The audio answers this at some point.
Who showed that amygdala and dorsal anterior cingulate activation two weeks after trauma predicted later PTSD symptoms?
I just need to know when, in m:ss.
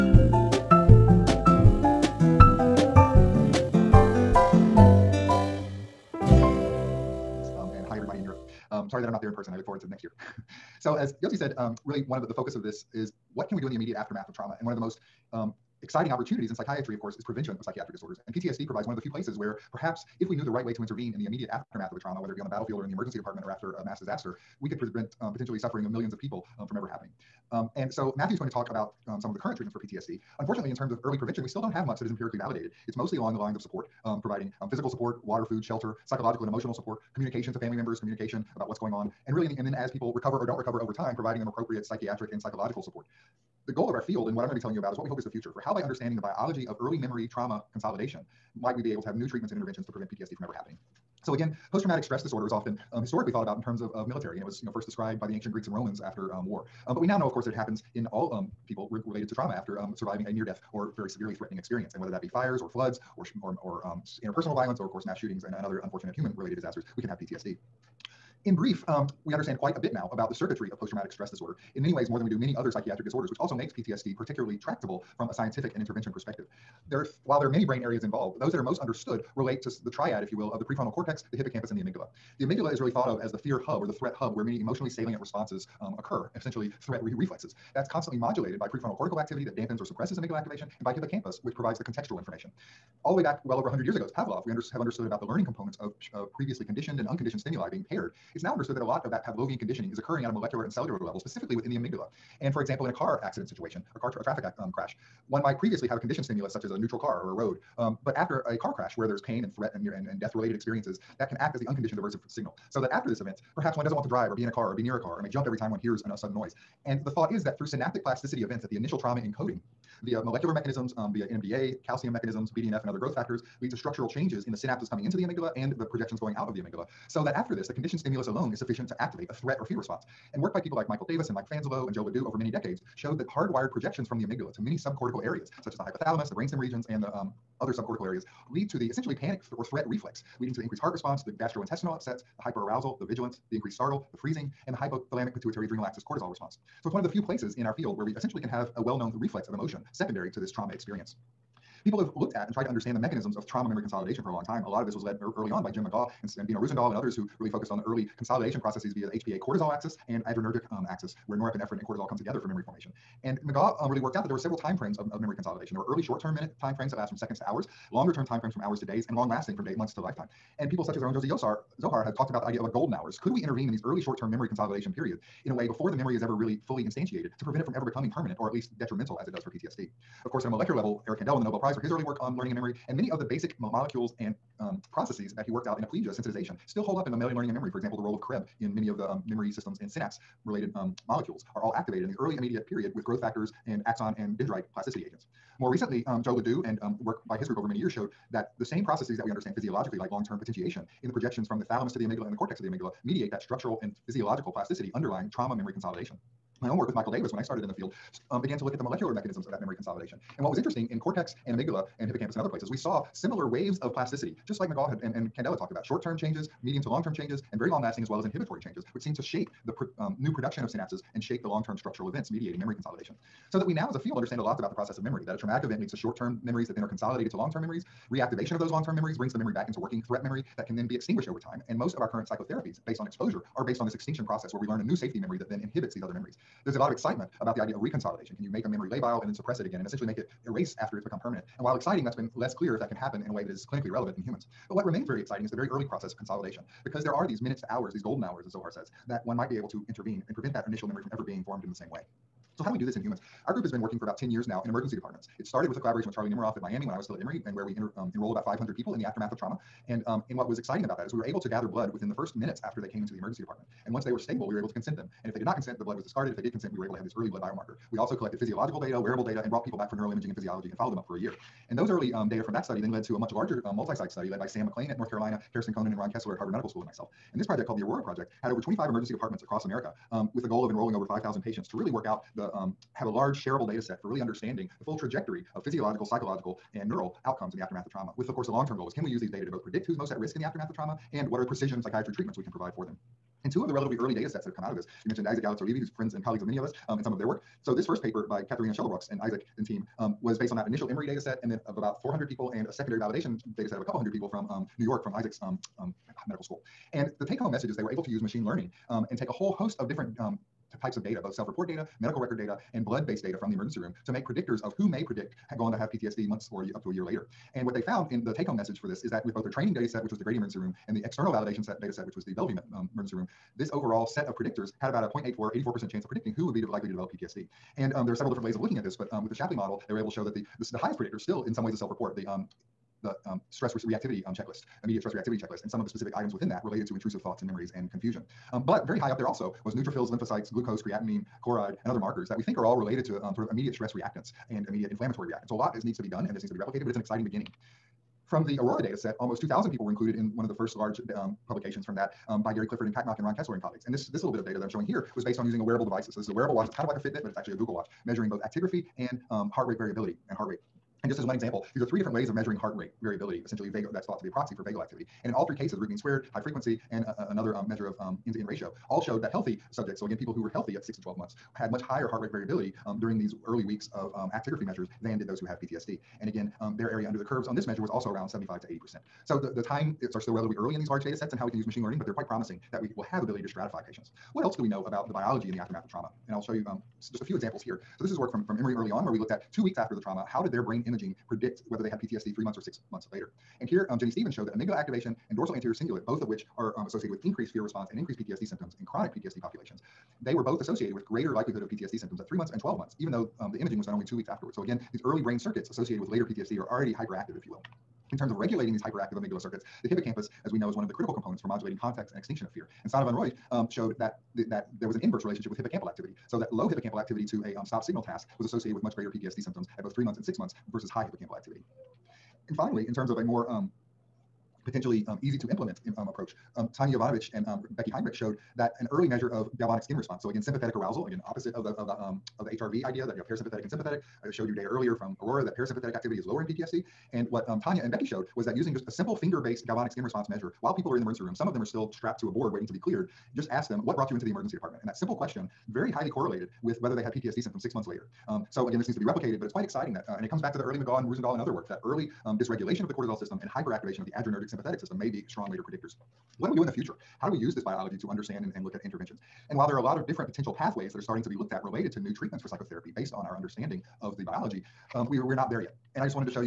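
6:33.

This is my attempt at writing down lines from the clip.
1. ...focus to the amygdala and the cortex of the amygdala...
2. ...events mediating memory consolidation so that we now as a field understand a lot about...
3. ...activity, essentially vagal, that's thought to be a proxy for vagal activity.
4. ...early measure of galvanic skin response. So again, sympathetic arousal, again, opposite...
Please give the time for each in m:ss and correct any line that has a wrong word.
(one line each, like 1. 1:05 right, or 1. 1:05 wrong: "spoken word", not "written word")
1. 3:21 wrong: "thalamus", not "focus"
2. 3:42 right
3. 6:03 wrong: "variability", not "activity"
4. 7:08 right.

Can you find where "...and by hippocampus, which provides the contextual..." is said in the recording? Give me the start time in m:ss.
1:30.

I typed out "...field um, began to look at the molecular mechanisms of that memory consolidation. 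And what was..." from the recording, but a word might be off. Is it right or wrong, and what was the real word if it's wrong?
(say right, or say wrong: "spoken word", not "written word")
right.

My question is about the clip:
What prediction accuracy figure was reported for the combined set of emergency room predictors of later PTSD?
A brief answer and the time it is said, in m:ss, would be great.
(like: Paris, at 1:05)
0.84, at 5:25.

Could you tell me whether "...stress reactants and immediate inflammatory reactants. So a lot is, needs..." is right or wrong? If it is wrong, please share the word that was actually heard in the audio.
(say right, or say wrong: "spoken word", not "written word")
right.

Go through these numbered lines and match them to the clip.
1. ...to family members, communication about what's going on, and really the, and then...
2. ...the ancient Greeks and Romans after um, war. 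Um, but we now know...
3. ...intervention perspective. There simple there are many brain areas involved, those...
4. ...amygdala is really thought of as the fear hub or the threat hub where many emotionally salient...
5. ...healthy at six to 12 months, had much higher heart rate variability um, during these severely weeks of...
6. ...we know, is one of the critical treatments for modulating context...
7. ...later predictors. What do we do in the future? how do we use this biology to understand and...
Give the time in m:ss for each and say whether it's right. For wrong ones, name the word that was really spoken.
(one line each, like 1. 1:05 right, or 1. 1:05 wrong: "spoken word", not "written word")
1. 0:37 right
2. 0:55 right
3. 1:15 wrong: "while", not "simple"
4. 1:22 right
5. 6:10 wrong: "early", not "severely"
6. 6:50 wrong: "components", not "treatments"
7. 7:35 right.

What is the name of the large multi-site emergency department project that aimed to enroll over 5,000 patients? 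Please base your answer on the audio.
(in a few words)
Aurora Project.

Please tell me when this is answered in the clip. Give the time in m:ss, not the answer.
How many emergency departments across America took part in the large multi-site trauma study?
4:38.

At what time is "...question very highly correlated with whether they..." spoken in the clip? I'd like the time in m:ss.
7:25.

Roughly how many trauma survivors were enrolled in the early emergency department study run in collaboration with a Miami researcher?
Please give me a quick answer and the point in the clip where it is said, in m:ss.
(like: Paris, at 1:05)
500, at 4:18.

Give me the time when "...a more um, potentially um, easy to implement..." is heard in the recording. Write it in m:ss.
7:03.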